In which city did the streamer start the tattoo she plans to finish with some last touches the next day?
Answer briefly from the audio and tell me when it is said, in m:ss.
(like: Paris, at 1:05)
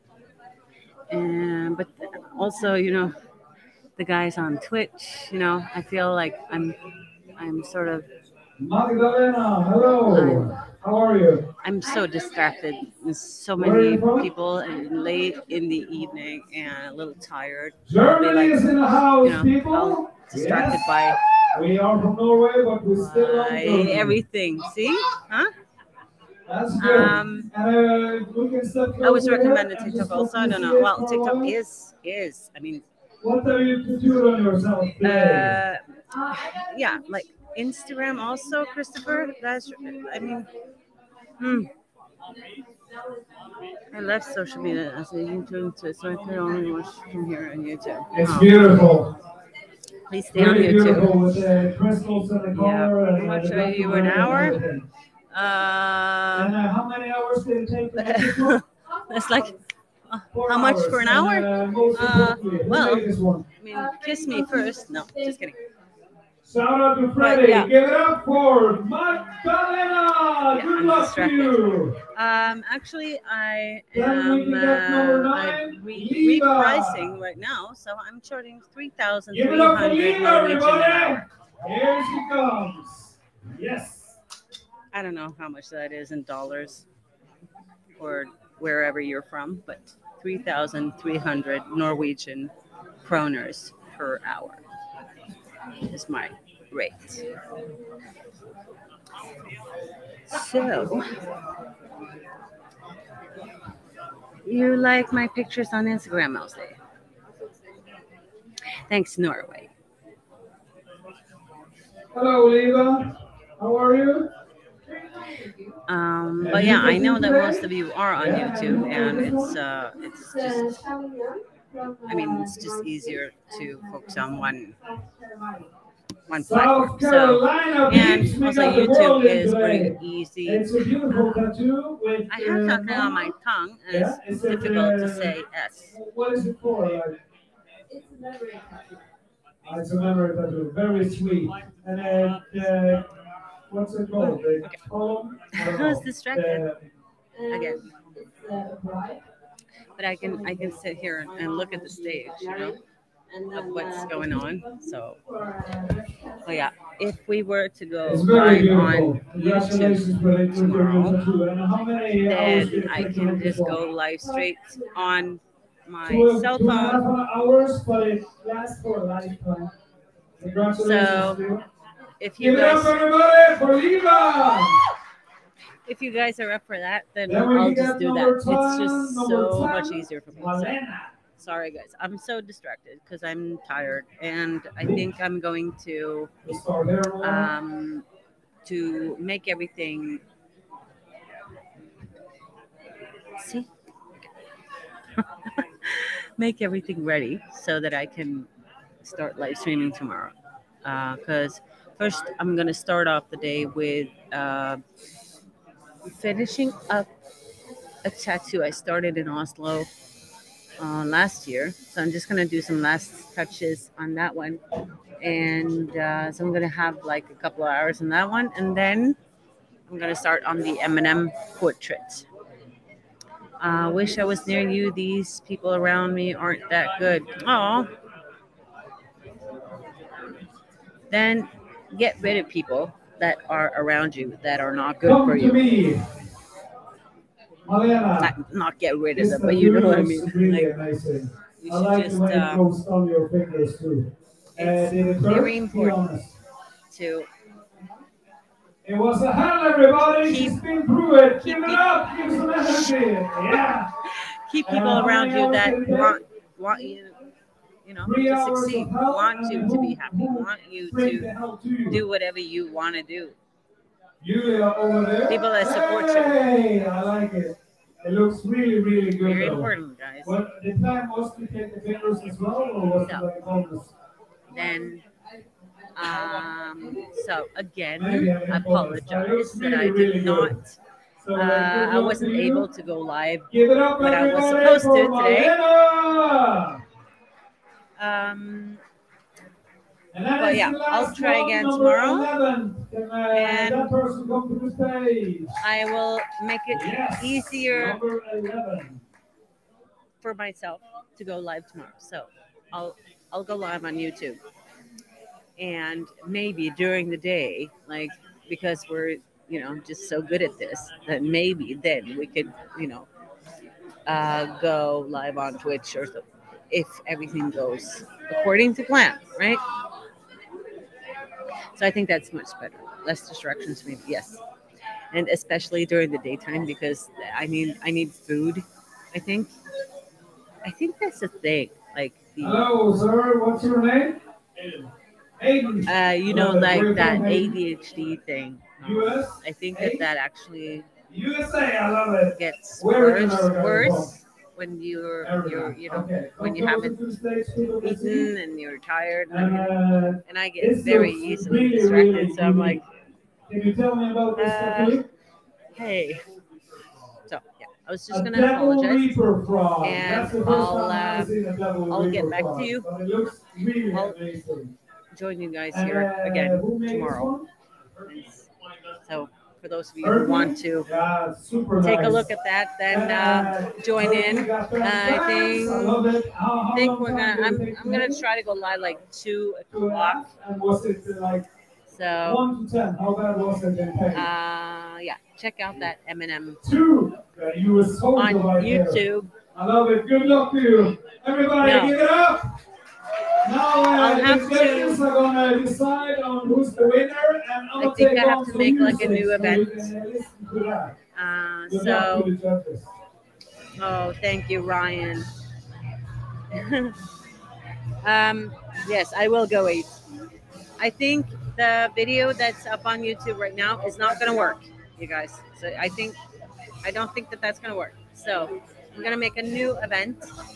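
Oslo, at 3:29.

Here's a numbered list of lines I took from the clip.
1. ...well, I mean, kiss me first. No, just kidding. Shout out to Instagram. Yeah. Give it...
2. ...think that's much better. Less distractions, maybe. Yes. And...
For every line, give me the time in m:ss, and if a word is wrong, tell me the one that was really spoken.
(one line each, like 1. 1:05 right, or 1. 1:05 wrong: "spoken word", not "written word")
1. 1:02 wrong: "Freddie", not "Instagram"
2. 5:21 right.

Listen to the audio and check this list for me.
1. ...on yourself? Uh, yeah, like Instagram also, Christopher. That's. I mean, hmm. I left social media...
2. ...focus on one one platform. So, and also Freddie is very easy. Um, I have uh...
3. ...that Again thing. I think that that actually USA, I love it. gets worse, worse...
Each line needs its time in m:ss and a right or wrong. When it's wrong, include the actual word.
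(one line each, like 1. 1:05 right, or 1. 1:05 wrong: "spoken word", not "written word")
1. 0:34 right
2. 2:03 wrong: "YouTube", not "Freddie"
3. 5:36 wrong: "ADHD", not "Again".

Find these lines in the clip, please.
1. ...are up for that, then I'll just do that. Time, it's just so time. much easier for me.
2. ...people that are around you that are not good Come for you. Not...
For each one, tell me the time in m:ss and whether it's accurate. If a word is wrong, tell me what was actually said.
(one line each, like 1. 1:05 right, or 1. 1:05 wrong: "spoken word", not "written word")
1. 2:56 right
2. 3:52 right.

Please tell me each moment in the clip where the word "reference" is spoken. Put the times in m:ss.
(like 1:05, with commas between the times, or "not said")
not said.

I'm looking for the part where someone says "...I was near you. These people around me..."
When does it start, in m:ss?
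3:44.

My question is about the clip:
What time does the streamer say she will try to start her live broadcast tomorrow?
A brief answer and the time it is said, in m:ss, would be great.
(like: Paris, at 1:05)
2 o'clock, at 6:19.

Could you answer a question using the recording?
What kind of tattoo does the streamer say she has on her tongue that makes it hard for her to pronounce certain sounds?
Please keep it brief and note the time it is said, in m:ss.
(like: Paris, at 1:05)
memory tattoo, at 2:19.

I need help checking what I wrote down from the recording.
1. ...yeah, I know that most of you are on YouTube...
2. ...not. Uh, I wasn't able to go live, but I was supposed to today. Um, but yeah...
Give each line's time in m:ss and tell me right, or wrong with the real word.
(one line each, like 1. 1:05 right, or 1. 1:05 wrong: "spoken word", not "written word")
1. 1:56 right
2. 4:40 right.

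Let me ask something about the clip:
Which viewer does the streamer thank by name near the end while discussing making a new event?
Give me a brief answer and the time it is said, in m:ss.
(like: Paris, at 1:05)
Ryan, at 6:44.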